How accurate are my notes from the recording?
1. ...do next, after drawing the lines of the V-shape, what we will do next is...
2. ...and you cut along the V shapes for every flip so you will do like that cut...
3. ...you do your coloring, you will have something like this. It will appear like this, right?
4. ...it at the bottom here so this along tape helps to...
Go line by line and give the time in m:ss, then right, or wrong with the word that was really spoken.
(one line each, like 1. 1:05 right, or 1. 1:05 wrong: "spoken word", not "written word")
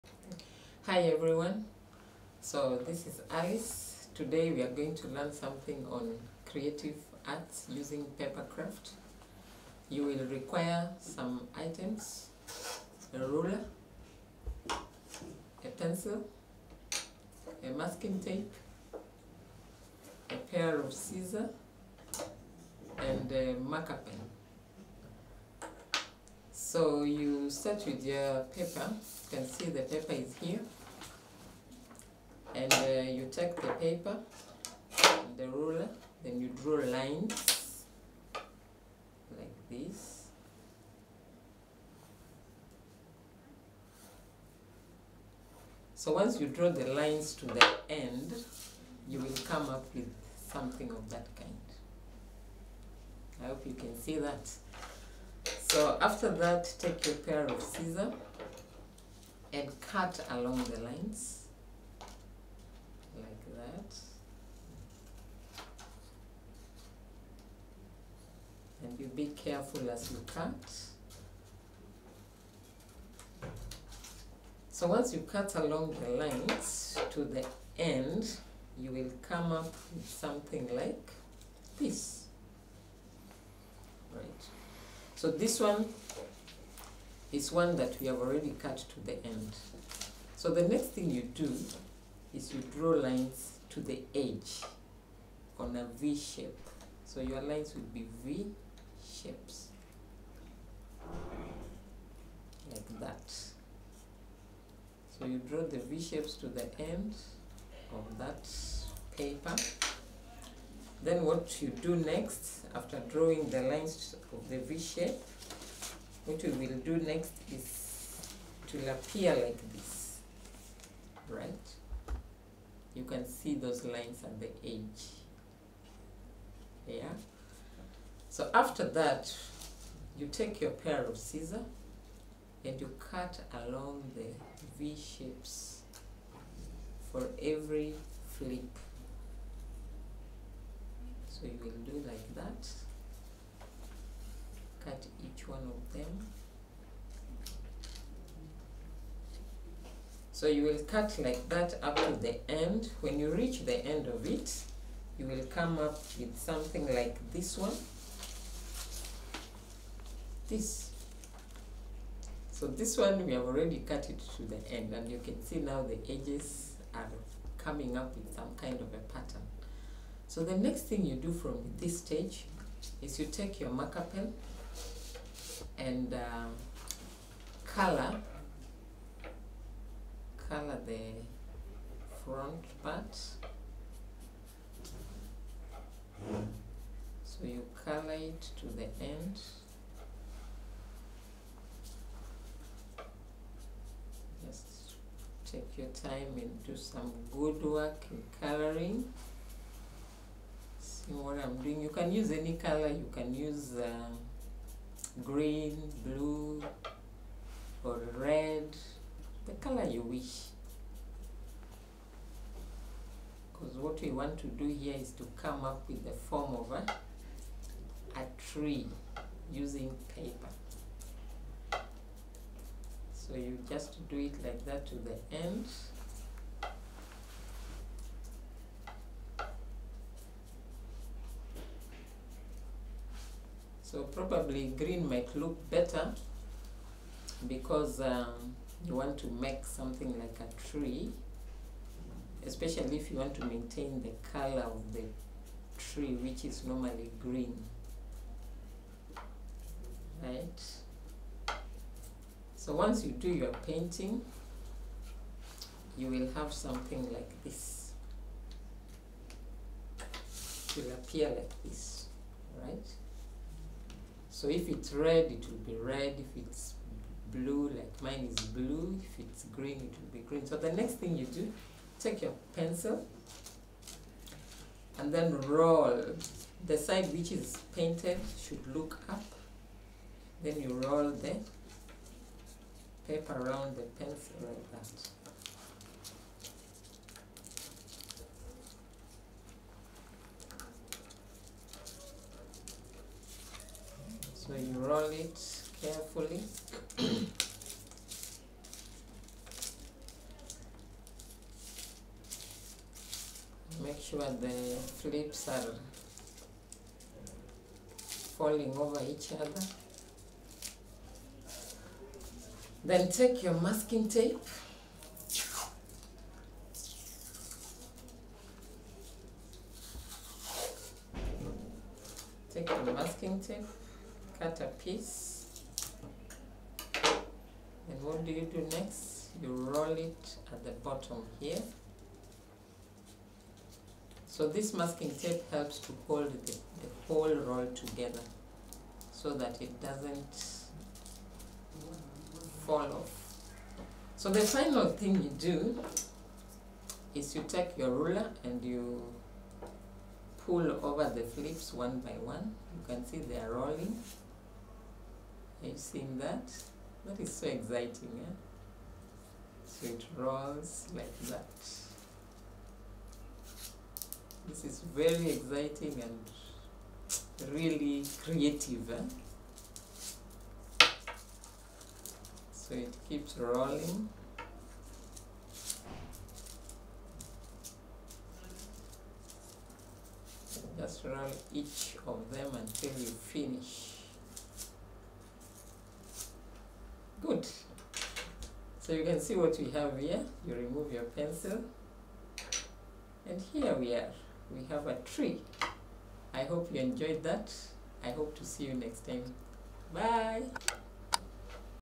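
1. 1:51 right
2. 2:12 right
3. 4:13 wrong: "painting", not "coloring"
4. 5:30 wrong: "masking", not "along".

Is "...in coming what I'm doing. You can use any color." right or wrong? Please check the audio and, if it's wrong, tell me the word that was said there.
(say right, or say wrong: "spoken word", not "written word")
wrong: "coloring", not "coming".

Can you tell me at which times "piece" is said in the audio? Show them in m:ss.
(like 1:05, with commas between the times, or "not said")
5:24.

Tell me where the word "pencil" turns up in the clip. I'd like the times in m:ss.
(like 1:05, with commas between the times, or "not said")
0:15, 4:32, 4:44, 6:31.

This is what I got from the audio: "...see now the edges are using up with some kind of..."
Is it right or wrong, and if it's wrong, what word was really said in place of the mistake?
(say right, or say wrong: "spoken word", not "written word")
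wrong: "coming", not "using".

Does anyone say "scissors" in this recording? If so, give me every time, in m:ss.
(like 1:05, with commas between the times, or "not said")
0:20, 0:57, 2:11.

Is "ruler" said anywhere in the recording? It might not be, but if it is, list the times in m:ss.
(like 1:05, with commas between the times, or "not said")
0:13, 0:35, 5:47.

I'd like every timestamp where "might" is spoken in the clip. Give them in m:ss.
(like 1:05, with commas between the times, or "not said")
3:55.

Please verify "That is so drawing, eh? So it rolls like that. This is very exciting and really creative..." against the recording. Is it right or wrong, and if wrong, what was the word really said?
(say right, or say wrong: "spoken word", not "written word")
wrong: "exciting", not "drawing".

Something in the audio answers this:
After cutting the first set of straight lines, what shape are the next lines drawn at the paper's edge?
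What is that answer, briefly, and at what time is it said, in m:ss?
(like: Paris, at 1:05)
V shape, at 1:35.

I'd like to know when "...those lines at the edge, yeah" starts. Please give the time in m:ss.
2:03.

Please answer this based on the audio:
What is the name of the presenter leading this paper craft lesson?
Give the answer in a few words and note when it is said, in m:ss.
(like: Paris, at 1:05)
Alice, at 0:03.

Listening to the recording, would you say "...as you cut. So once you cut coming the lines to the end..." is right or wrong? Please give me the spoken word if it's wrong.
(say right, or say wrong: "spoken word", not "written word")
wrong: "along", not "coming".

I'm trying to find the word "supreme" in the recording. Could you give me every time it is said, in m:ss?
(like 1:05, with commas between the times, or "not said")
not said.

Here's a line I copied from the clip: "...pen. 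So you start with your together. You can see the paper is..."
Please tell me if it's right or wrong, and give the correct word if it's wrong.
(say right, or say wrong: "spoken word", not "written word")
wrong: "paper", not "together".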